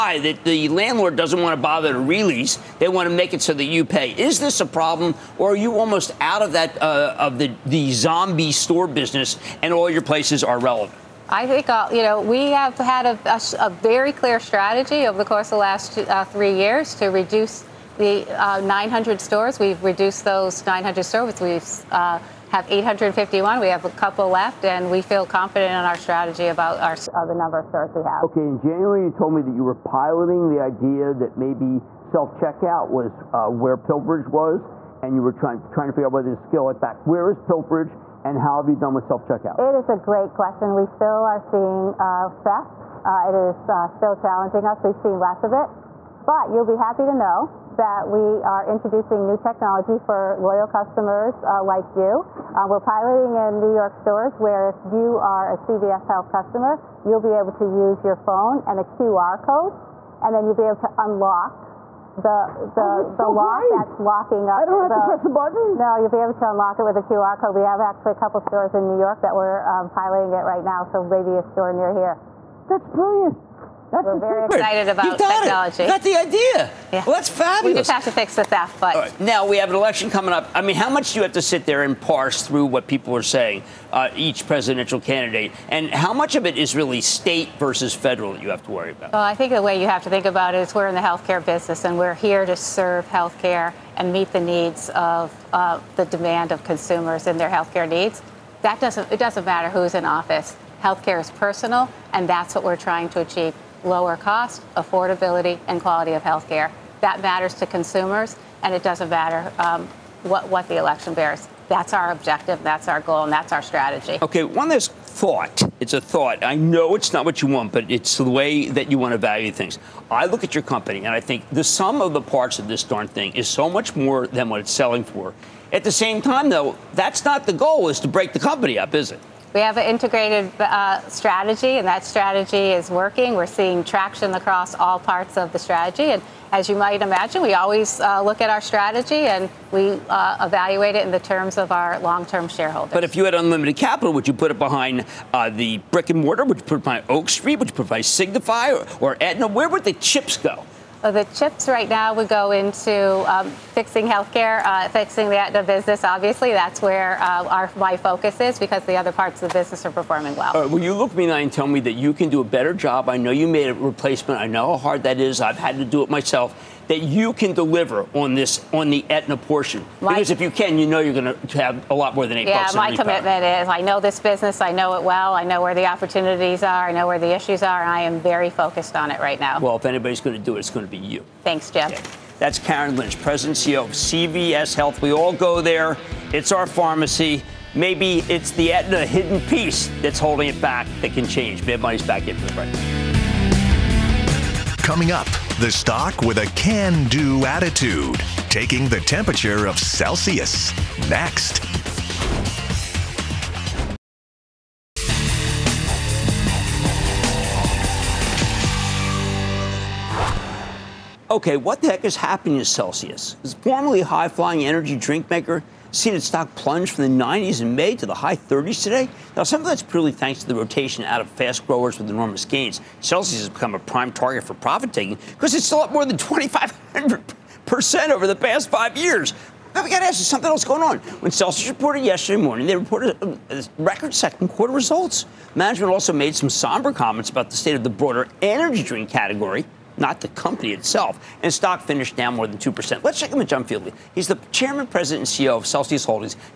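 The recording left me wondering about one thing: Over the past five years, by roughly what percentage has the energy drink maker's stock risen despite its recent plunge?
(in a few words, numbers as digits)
2,500%.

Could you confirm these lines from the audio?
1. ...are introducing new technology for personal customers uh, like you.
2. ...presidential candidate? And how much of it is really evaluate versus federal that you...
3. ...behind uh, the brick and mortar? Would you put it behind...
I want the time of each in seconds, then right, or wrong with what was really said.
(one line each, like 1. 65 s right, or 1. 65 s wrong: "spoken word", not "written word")
1. 48 s wrong: "loyal", not "personal"
2. 84 s wrong: "state", not "evaluate"
3. 144 s right.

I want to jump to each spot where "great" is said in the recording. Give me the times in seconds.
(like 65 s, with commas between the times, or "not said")
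39 s, 63 s.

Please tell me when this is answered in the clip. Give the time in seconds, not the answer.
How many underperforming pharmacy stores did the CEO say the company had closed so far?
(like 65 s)
22 s.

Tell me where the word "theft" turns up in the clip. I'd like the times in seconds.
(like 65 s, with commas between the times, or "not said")
42 s, 78 s.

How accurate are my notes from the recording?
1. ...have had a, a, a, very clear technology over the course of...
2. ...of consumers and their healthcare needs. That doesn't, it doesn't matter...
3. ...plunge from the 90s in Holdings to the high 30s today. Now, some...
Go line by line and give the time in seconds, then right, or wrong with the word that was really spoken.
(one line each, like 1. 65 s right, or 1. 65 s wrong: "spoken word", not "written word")
1. 12 s wrong: "strategy", not "technology"
2. 96 s right
3. 216 s wrong: "May", not "Holdings".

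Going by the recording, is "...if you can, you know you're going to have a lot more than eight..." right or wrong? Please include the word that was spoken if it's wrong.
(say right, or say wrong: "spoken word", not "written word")
right.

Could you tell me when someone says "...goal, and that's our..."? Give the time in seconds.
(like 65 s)
113 s.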